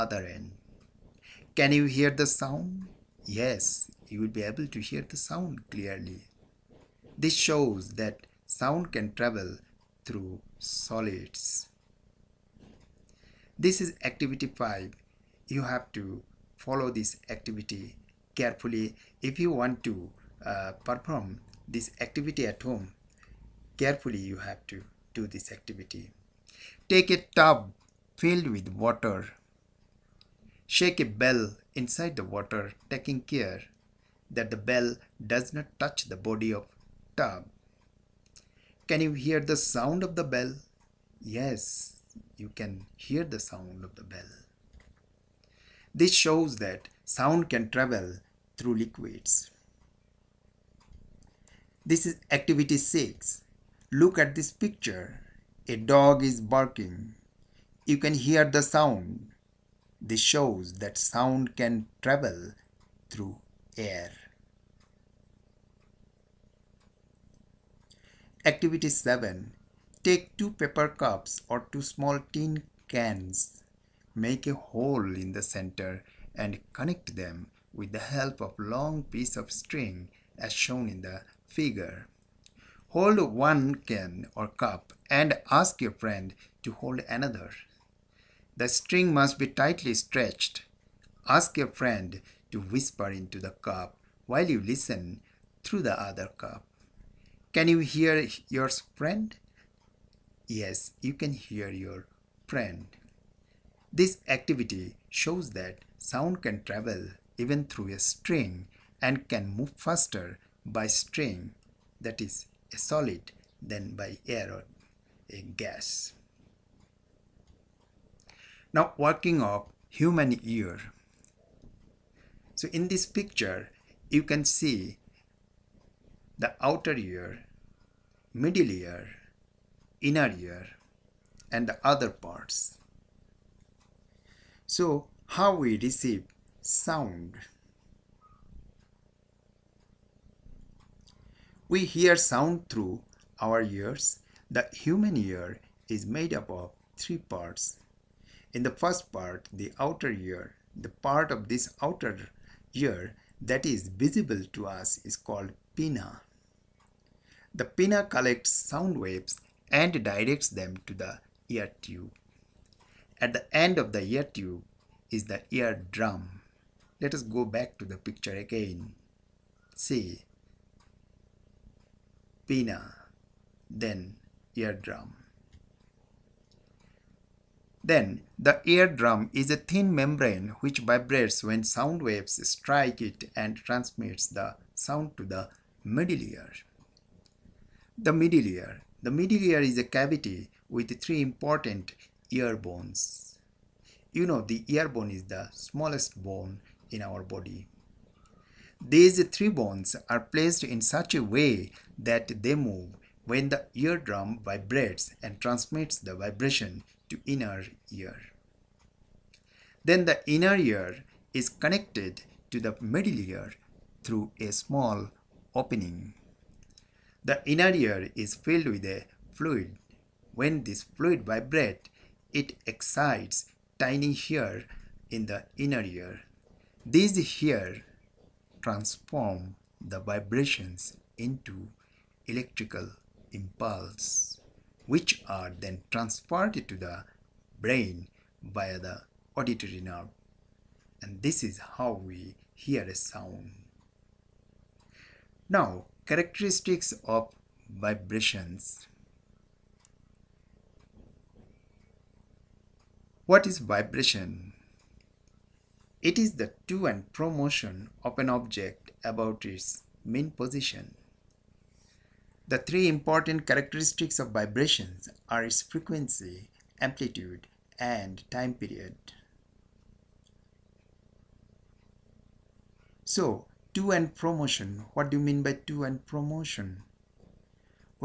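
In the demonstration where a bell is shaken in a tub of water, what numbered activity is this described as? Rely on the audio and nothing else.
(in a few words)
Activity 6.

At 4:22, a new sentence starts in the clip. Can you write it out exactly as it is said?
The three important characteristics of vibrations are its frequency, amplitude, and time period.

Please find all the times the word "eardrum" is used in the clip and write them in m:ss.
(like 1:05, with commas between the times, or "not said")
2:54, 2:58, 3:23.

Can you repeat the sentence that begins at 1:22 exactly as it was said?
Hold one can or cup and ask your friend to hold another.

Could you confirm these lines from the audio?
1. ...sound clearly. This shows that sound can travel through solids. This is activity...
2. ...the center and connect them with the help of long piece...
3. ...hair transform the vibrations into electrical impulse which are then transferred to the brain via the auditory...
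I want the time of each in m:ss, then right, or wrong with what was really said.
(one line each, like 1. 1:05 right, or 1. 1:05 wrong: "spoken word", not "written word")
1. 0:05 right
2. 1:15 right
3. 3:47 right.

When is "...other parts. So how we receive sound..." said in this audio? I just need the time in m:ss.
2:11.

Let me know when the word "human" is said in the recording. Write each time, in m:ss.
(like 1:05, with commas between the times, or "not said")
1:59, 2:24.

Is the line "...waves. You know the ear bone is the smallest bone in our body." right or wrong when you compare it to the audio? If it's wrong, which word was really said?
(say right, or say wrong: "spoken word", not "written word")
wrong: "bones", not "waves".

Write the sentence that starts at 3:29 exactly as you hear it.
Then the inner ear is connected to the middle ear through a small opening.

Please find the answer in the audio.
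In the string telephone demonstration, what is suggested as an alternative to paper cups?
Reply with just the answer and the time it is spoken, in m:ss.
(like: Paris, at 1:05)
Small tin cans, at 1:11.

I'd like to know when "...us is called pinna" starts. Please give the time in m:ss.
2:34.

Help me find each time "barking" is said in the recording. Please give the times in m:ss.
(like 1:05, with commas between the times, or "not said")
0:56.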